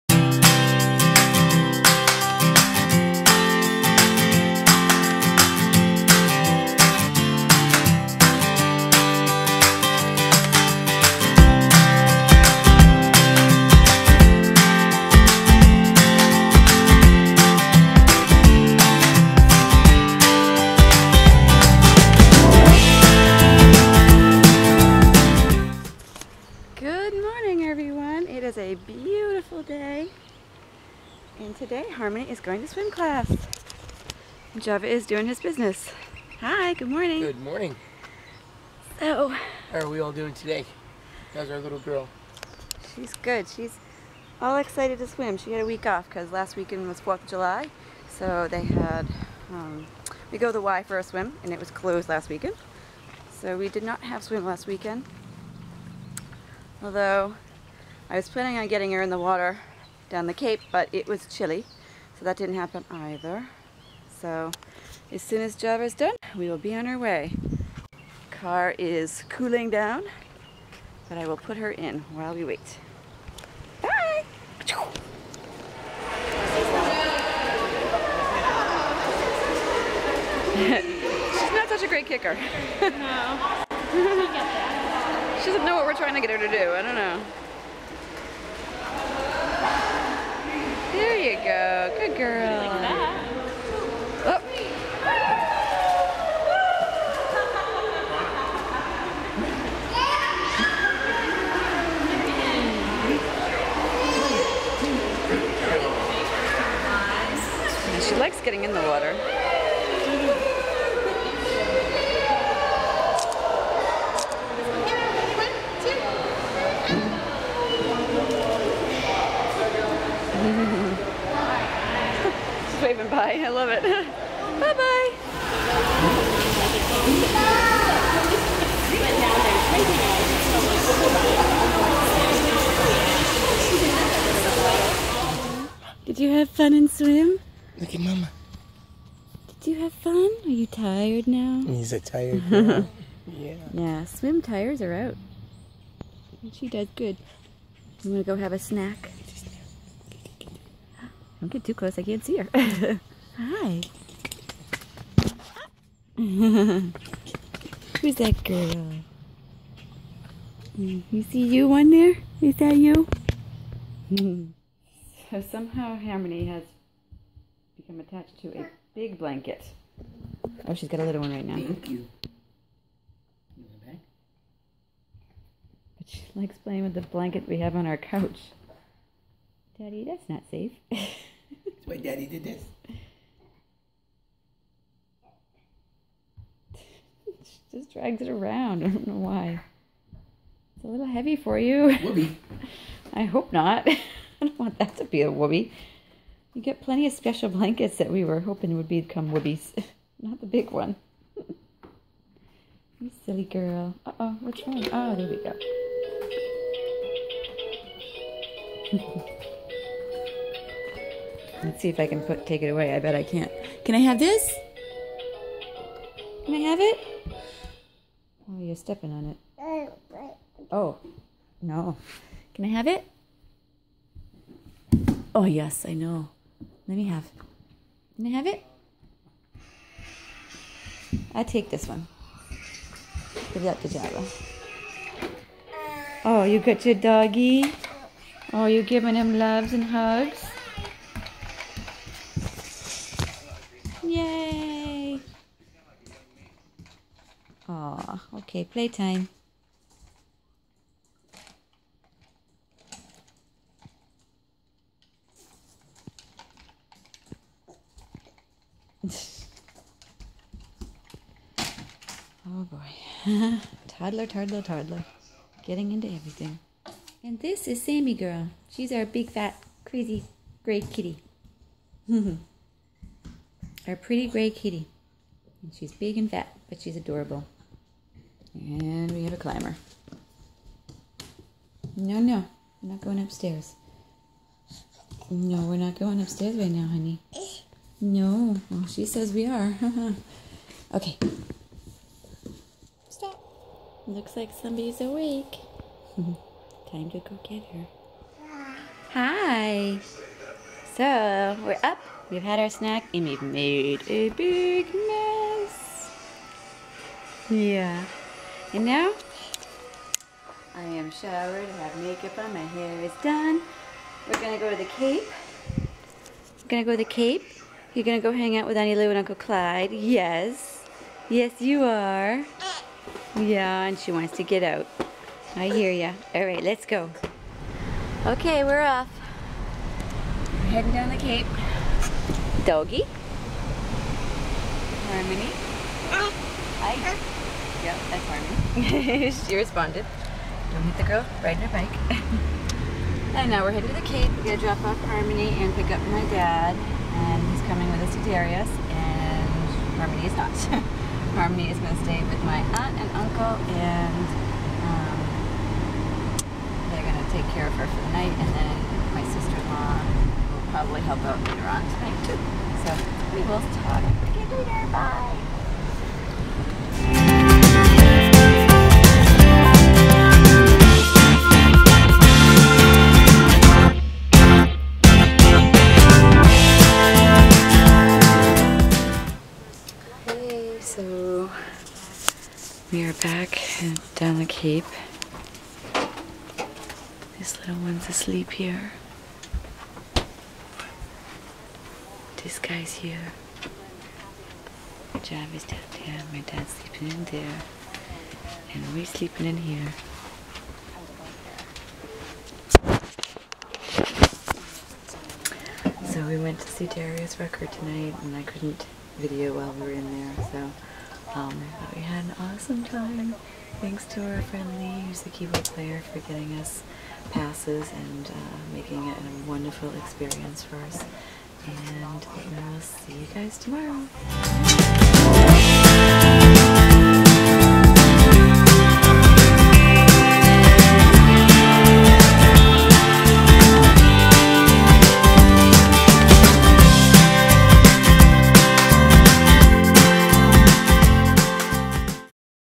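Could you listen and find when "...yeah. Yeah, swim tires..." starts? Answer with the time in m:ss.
2:23.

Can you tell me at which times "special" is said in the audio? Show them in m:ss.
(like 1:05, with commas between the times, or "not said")
3:17.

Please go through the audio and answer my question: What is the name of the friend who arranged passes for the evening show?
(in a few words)
Lee.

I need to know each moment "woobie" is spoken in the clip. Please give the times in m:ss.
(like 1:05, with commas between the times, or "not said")
3:15, 3:19.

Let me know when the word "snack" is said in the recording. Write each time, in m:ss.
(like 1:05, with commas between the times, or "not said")
2:28, 5:02.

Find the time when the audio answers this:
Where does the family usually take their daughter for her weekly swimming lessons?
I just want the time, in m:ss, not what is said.
0:50.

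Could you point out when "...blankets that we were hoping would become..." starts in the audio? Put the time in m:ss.
3:17.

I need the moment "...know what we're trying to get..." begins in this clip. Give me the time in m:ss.
1:25.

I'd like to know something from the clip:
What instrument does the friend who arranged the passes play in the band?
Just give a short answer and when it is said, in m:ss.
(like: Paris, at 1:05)
Keyboard, at 6:55.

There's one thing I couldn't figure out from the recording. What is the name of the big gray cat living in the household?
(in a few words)
Sammy Girl.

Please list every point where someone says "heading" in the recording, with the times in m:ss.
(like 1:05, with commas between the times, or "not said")
5:30, 5:43.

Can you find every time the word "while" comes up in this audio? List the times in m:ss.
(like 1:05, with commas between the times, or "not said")
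1:12, 6:49.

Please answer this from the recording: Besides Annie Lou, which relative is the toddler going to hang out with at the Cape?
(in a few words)
Uncle Clyde.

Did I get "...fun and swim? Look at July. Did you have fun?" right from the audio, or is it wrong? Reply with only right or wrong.
wrong.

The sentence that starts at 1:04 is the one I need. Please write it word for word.
So as soon as Java's done, we will be on our way.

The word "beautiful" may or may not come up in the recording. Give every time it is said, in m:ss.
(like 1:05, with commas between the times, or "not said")
0:28.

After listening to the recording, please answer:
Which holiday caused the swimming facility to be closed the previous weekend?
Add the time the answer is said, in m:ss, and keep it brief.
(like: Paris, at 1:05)
4th of July, at 0:46.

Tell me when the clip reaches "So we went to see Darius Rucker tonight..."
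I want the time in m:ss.
6:46.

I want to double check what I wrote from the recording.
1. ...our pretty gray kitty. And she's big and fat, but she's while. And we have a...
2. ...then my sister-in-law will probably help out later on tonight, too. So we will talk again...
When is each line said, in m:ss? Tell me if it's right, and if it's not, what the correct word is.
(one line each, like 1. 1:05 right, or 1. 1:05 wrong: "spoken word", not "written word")
1. 4:33 wrong: "adorable", not "while"
2. 5:58 right.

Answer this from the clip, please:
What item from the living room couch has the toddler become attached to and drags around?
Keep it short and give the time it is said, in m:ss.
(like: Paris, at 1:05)
Big blanket, at 2:48.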